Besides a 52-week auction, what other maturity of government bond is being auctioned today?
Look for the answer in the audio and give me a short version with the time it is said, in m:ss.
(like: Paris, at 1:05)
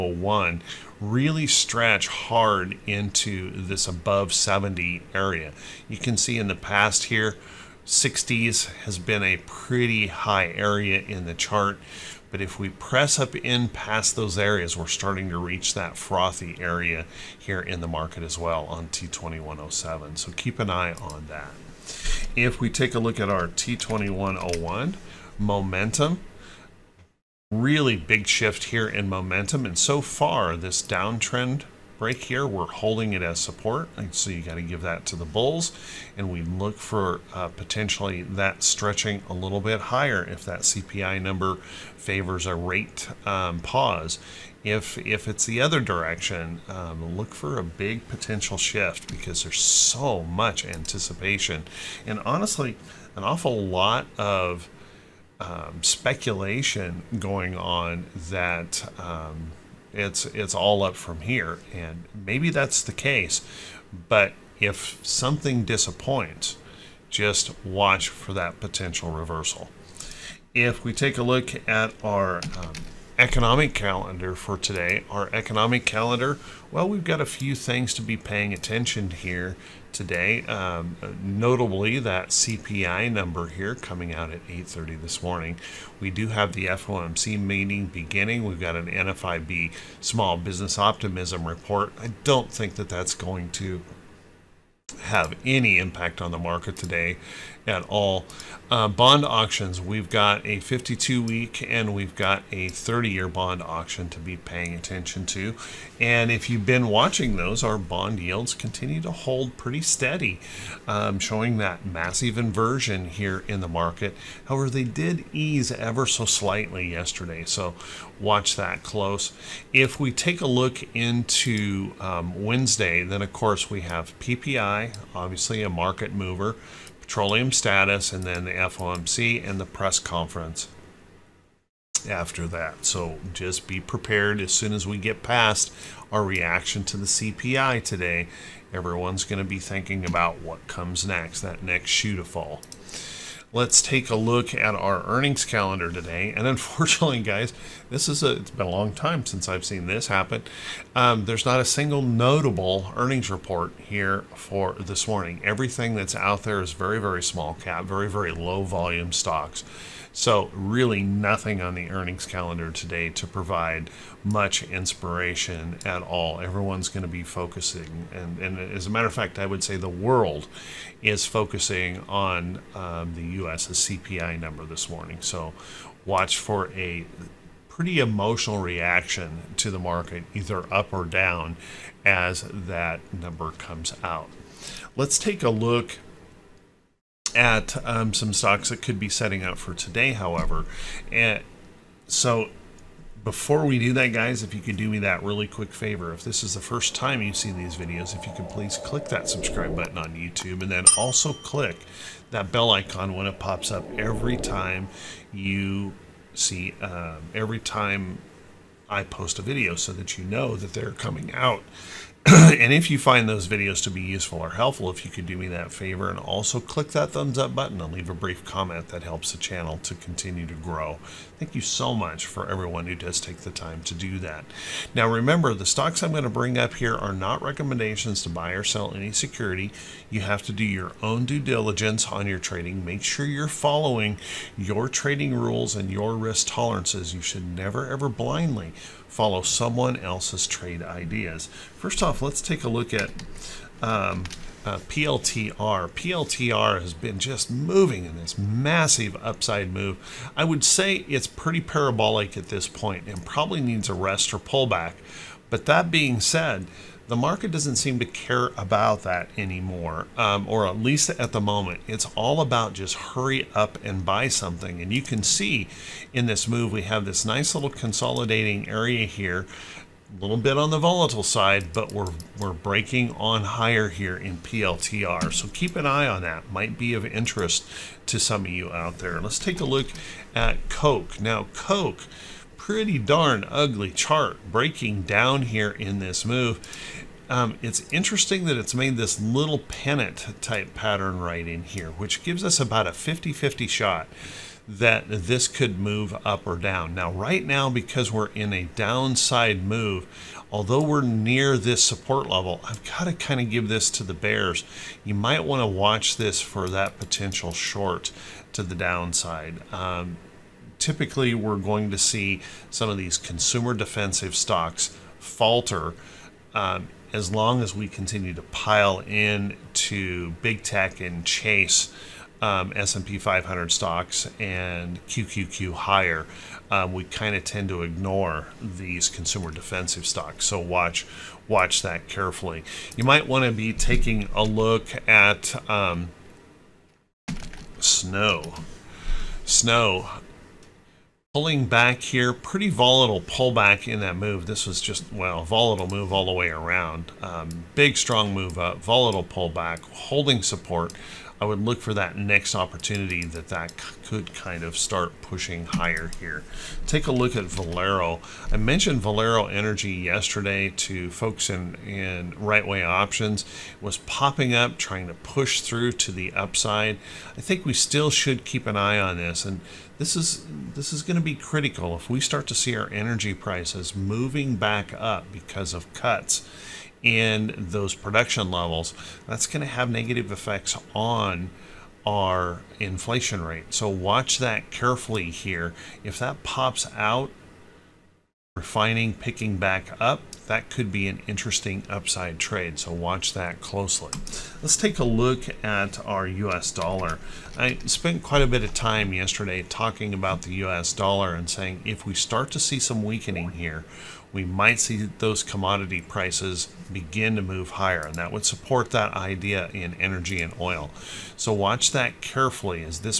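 30 year, at 1:42.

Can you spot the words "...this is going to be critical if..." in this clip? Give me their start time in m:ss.
6:10.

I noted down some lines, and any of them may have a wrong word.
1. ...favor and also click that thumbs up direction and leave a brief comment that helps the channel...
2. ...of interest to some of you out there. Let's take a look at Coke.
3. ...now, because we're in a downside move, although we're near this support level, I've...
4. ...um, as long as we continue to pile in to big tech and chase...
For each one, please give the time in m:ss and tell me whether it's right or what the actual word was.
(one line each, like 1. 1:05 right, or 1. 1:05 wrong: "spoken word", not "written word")
1. 3:35 wrong: "button", not "direction"
2. 4:36 right
3. 4:57 right
4. 5:16 right.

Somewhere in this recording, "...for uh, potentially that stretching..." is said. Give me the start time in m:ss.
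0:36.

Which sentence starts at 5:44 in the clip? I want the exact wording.
This was just, well, volatile move all the way around.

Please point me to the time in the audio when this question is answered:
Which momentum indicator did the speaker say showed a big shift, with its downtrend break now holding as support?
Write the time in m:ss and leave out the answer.
0:23.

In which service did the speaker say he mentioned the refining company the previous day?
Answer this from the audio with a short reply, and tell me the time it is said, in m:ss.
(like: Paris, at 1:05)
Right Way Options, at 6:02.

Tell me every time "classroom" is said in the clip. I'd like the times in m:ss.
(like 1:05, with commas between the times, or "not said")
not said.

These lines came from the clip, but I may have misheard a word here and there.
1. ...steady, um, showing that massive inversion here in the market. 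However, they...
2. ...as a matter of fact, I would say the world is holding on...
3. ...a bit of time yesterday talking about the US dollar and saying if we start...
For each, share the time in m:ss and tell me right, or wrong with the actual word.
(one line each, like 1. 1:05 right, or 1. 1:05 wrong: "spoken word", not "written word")
1. 1:49 right
2. 2:48 wrong: "focusing", not "holding"
3. 6:38 right.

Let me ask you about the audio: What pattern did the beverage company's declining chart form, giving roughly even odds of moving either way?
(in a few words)
pennant.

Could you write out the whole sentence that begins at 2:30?
Um, there's not a single notable earnings report here for this morning.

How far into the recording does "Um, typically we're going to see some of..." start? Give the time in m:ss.
5:09.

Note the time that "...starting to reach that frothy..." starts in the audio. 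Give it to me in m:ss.
0:14.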